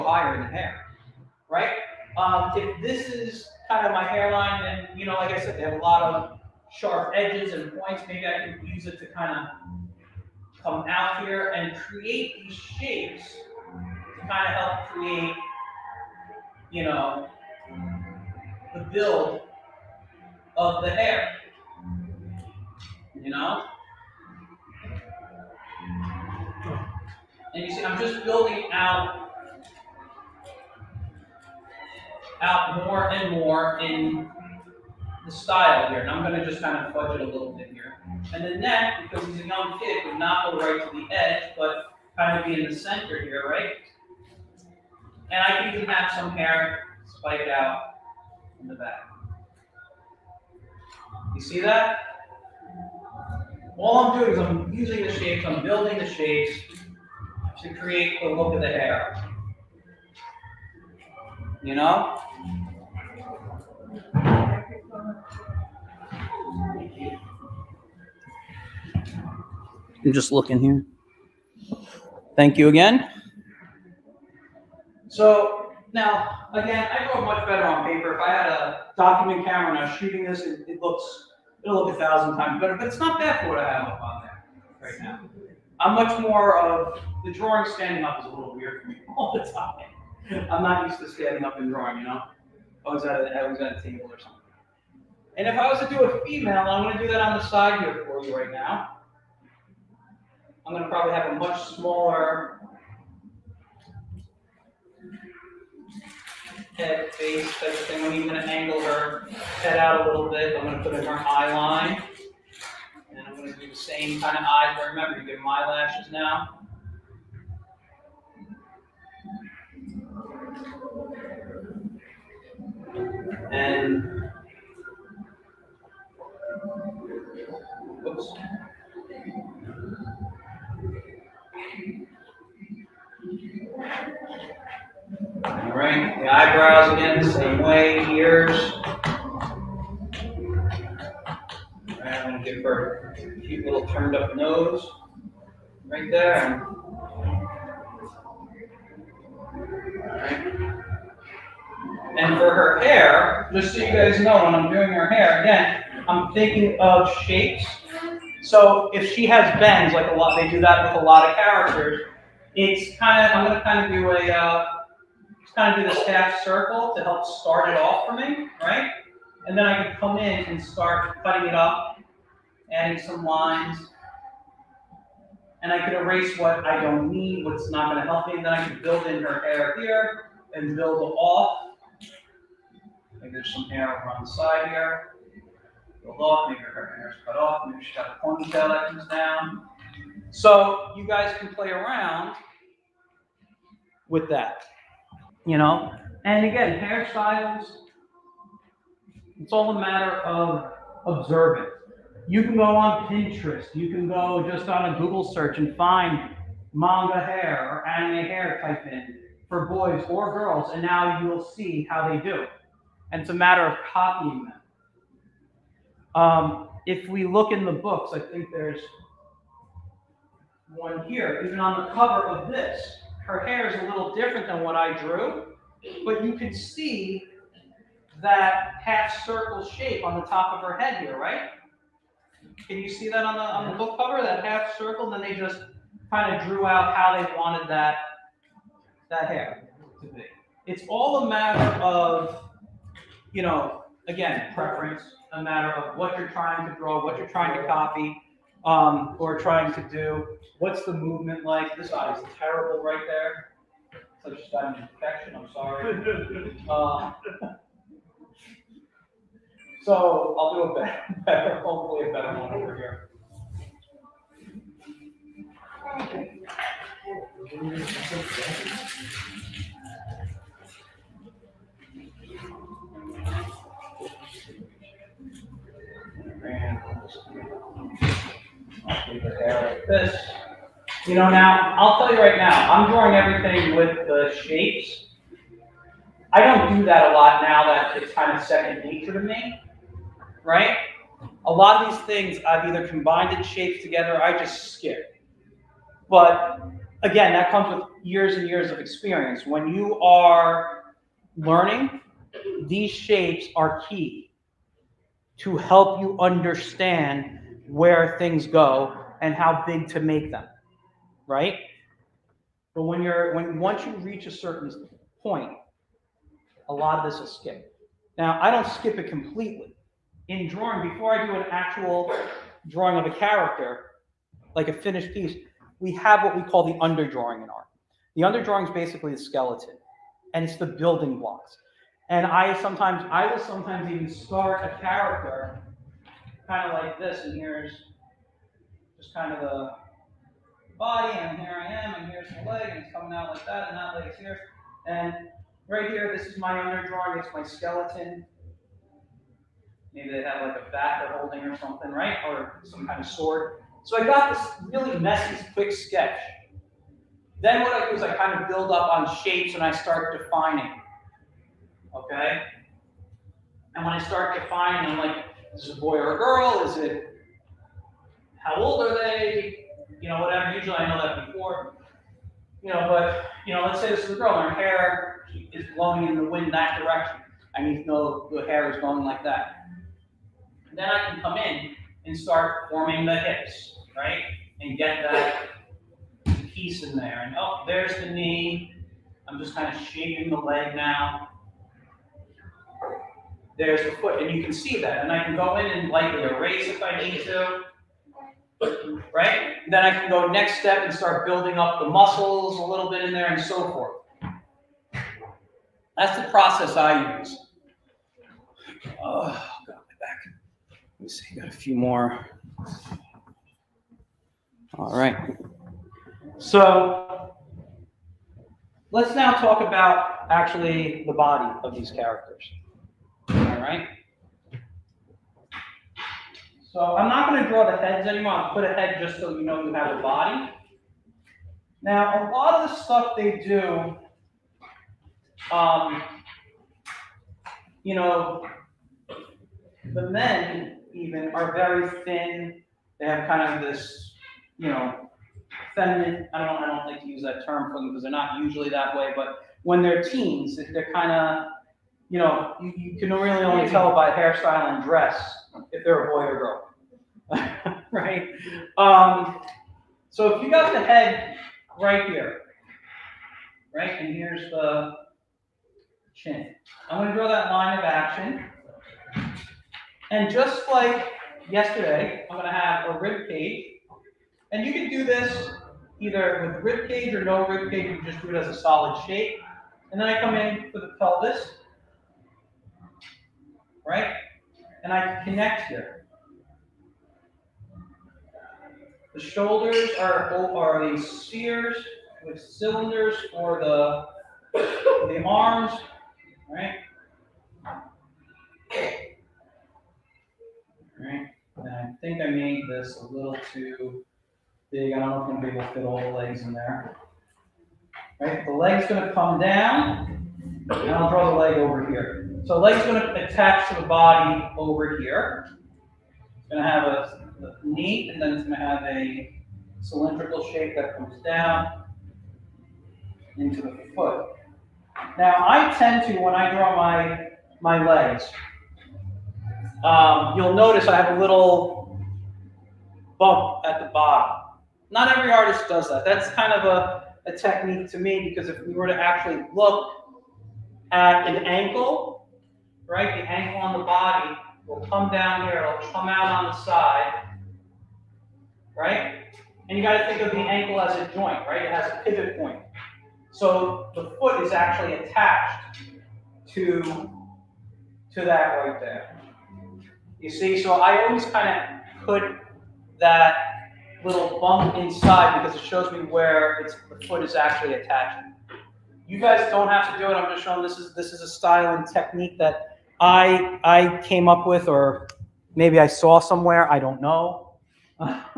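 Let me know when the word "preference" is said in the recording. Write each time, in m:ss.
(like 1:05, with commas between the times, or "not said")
4:04.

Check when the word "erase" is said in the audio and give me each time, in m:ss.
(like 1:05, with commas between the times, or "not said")
2:55, 6:36.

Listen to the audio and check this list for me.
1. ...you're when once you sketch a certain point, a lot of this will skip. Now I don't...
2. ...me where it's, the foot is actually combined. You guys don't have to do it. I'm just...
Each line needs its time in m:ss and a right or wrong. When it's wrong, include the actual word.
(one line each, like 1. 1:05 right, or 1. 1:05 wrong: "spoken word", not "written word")
1. 5:13 wrong: "reach", not "sketch"
2. 9:25 wrong: "attached", not "combined".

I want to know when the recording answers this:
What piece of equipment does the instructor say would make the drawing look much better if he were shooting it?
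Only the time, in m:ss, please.
1:18.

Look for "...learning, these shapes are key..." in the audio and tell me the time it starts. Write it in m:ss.
5:01.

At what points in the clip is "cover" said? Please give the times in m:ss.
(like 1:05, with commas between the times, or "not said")
3:41, 3:53.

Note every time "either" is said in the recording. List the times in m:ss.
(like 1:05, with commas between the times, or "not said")
4:52, 7:55.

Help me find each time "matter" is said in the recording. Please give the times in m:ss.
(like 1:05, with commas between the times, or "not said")
3:19, 3:33, 4:01, 4:05.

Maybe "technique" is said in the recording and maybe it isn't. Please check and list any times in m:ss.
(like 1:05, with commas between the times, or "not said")
8:57, 9:31.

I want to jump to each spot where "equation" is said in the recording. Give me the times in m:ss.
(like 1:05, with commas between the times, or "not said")
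not said.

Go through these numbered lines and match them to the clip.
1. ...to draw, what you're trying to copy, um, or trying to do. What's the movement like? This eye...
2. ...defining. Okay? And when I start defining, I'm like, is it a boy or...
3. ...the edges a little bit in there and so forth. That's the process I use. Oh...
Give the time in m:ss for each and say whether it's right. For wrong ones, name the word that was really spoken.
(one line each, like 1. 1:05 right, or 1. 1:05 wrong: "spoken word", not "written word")
1. 4:06 right
2. 6:00 right
3. 6:41 wrong: "muscles", not "edges".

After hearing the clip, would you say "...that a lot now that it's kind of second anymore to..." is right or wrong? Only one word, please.
wrong.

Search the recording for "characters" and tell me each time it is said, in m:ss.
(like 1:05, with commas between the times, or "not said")
2:41, 5:23, 5:34, 7:01.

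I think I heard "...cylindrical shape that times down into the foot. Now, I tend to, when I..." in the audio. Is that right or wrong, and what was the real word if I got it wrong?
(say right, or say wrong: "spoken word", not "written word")
wrong: "comes", not "times".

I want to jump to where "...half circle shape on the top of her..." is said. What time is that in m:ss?
3:48.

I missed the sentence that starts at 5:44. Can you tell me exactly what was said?
And right here, this is my drawing.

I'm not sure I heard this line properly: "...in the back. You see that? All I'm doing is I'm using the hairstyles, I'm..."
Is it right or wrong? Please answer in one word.
wrong.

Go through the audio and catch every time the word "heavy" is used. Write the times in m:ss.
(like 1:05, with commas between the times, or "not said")
not said.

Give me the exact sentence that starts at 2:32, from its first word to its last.
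And for her hair, just so you guys know, when I'm doing her hair, again, I'm thinking of shapes.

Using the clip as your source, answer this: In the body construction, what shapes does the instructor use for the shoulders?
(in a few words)
spheres.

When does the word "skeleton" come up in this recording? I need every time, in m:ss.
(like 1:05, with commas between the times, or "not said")
5:29, 5:47.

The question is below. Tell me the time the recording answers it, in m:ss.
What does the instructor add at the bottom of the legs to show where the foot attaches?
8:51.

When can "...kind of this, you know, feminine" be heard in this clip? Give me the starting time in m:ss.
7:23.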